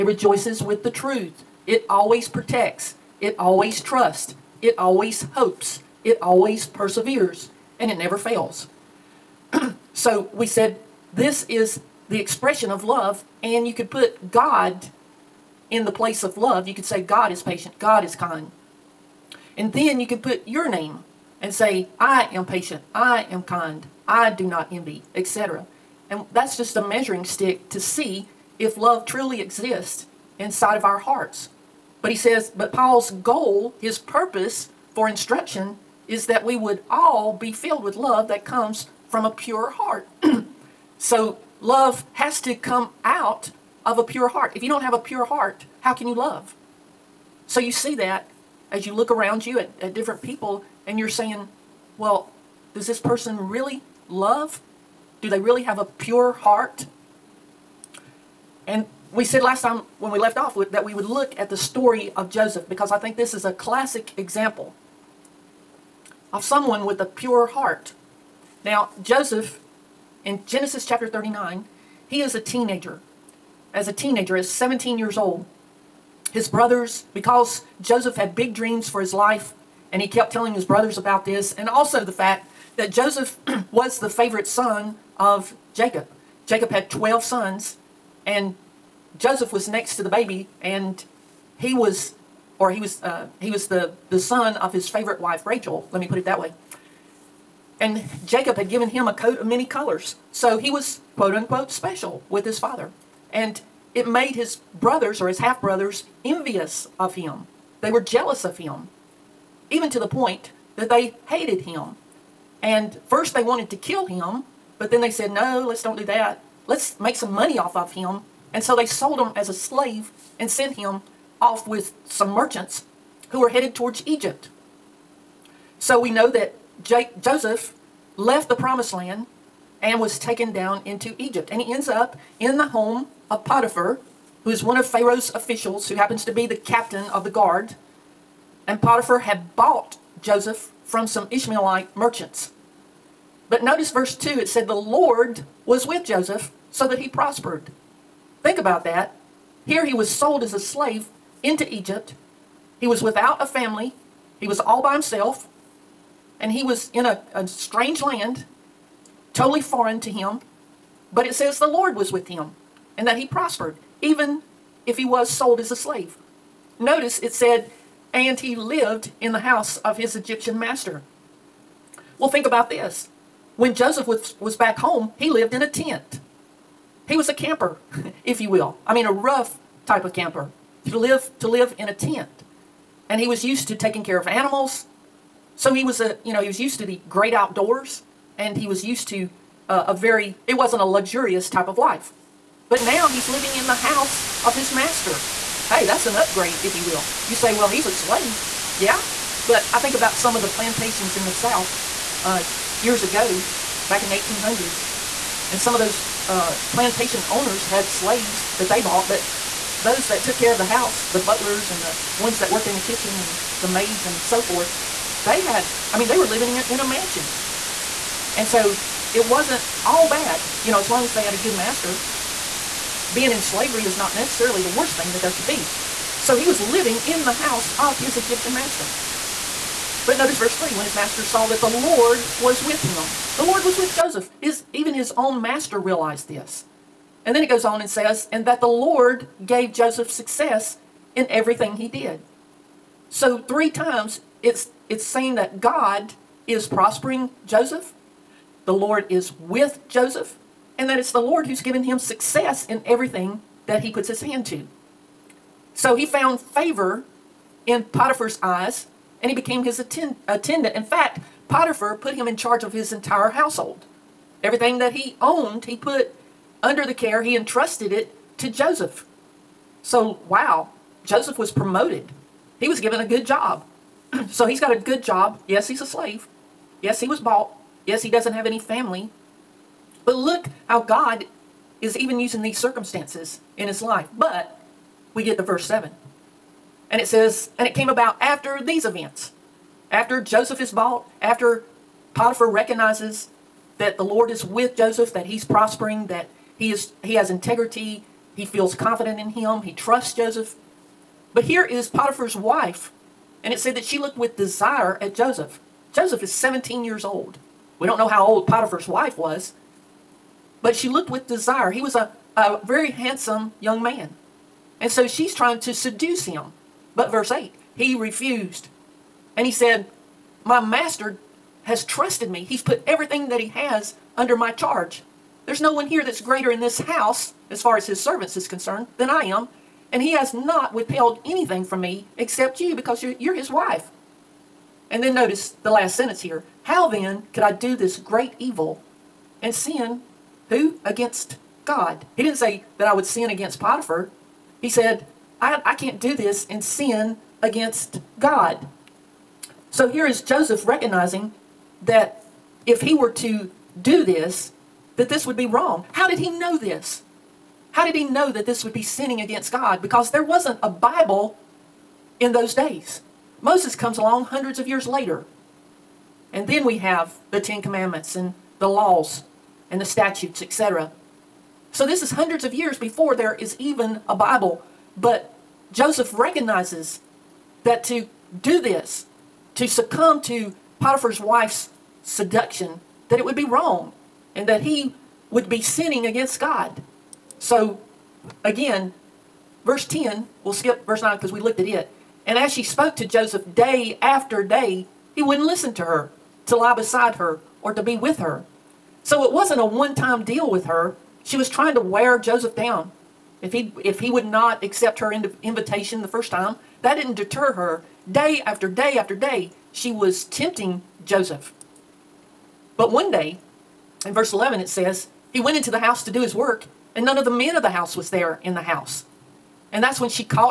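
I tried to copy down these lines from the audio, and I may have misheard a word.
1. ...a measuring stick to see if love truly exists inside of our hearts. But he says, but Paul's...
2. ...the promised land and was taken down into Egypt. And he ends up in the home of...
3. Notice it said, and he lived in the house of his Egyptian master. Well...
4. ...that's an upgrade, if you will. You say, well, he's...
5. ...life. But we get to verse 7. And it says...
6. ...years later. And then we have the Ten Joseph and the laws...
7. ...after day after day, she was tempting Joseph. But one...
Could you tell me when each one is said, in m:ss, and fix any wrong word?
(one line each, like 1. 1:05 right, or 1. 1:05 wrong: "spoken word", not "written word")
1. 0:26 right
2. 2:08 right
3. 2:46 right
4. 3:15 right
5. 4:43 right
6. 6:04 wrong: "Commandments", not "Joseph"
7. 6:48 right.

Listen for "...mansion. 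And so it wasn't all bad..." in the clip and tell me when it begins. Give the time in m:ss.
3:36.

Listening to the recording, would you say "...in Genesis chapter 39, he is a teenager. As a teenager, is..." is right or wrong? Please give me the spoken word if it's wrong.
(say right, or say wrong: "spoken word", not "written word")
right.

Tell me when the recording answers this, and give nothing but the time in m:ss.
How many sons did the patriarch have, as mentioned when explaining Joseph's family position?
1:26.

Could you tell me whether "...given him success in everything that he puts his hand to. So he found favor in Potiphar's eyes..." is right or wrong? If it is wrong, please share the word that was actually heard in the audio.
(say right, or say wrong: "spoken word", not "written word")
right.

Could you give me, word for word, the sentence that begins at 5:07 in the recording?
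We don't know how old Potiphar's wife was, but she looked with desire.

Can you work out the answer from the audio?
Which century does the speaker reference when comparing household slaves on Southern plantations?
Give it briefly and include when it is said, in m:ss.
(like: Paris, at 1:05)
1800s, at 3:24.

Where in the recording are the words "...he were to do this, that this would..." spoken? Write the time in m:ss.
5:52.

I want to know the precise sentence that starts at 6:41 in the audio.
She was trying to wear Joseph down.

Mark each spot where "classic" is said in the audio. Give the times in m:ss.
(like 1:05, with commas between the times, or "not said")
1:03.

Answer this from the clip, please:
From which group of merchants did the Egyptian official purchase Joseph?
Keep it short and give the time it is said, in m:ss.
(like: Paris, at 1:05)
Ishmaelite merchants, at 2:21.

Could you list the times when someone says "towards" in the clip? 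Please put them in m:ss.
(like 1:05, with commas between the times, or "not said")
2:03.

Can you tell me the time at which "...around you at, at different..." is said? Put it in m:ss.
0:49.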